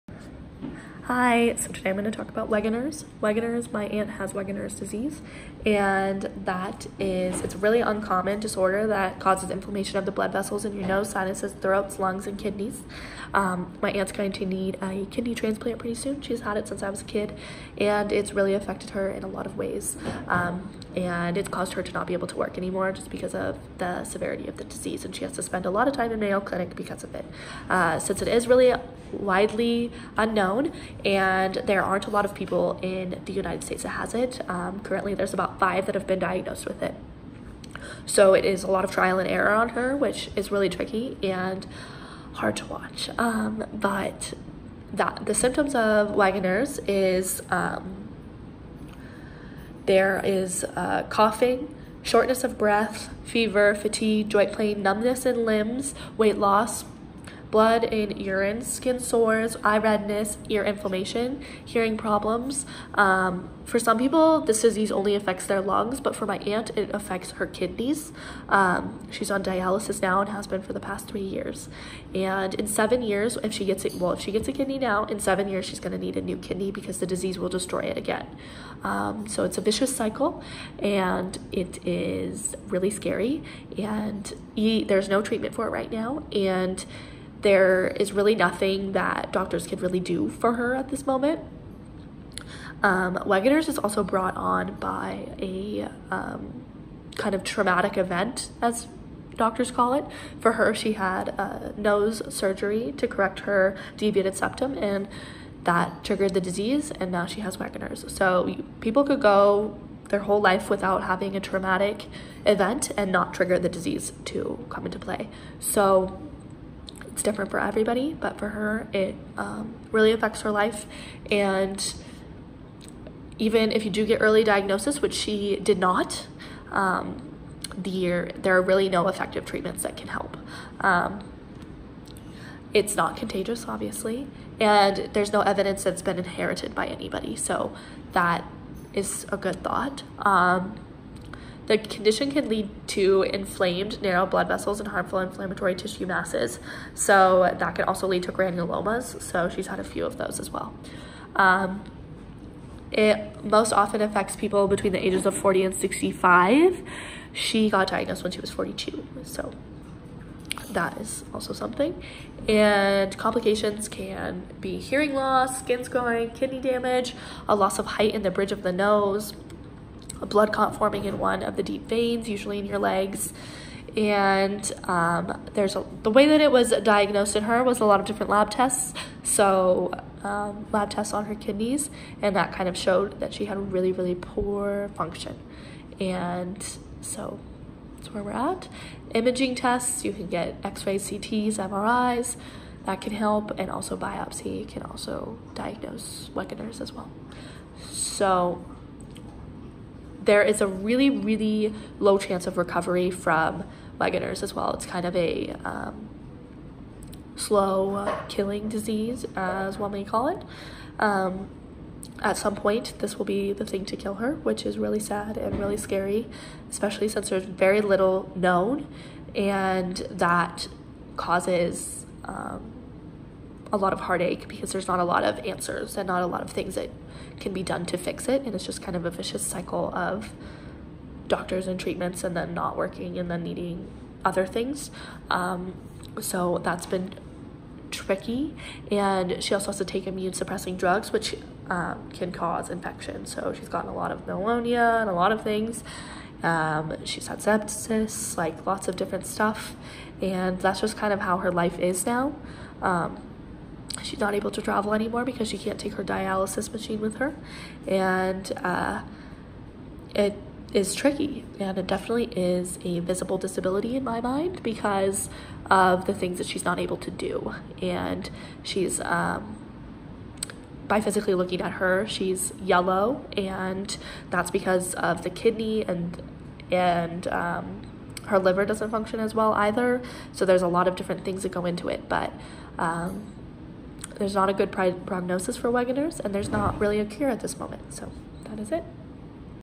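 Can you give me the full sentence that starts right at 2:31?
Um, it most often affects people between the ages of 40 and 65.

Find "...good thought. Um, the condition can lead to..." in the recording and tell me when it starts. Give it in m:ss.
2:19.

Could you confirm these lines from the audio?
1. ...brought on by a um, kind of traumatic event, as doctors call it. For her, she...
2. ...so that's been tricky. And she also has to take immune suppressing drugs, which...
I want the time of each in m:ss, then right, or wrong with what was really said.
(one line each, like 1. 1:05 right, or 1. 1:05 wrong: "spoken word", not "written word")
1. 1:34 right
2. 3:56 right.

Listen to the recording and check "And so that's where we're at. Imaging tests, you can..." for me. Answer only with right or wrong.
right.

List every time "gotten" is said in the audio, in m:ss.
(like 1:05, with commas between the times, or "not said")
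4:03.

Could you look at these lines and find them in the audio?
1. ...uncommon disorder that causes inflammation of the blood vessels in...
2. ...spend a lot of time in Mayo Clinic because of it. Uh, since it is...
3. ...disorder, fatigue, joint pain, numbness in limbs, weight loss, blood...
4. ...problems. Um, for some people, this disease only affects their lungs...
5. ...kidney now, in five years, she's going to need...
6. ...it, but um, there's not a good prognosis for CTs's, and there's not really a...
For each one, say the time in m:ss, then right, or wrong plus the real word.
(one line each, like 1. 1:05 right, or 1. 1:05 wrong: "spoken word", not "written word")
1. 0:07 right
2. 0:25 right
3. 0:53 wrong: "fever", not "disorder"
4. 1:01 right
5. 1:14 wrong: "seven", not "five"
6. 4:41 wrong: "Wegener", not "CTs".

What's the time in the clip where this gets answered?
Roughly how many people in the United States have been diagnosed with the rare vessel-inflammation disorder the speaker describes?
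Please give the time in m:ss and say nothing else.
0:35.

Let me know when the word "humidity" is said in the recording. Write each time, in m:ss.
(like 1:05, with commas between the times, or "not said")
not said.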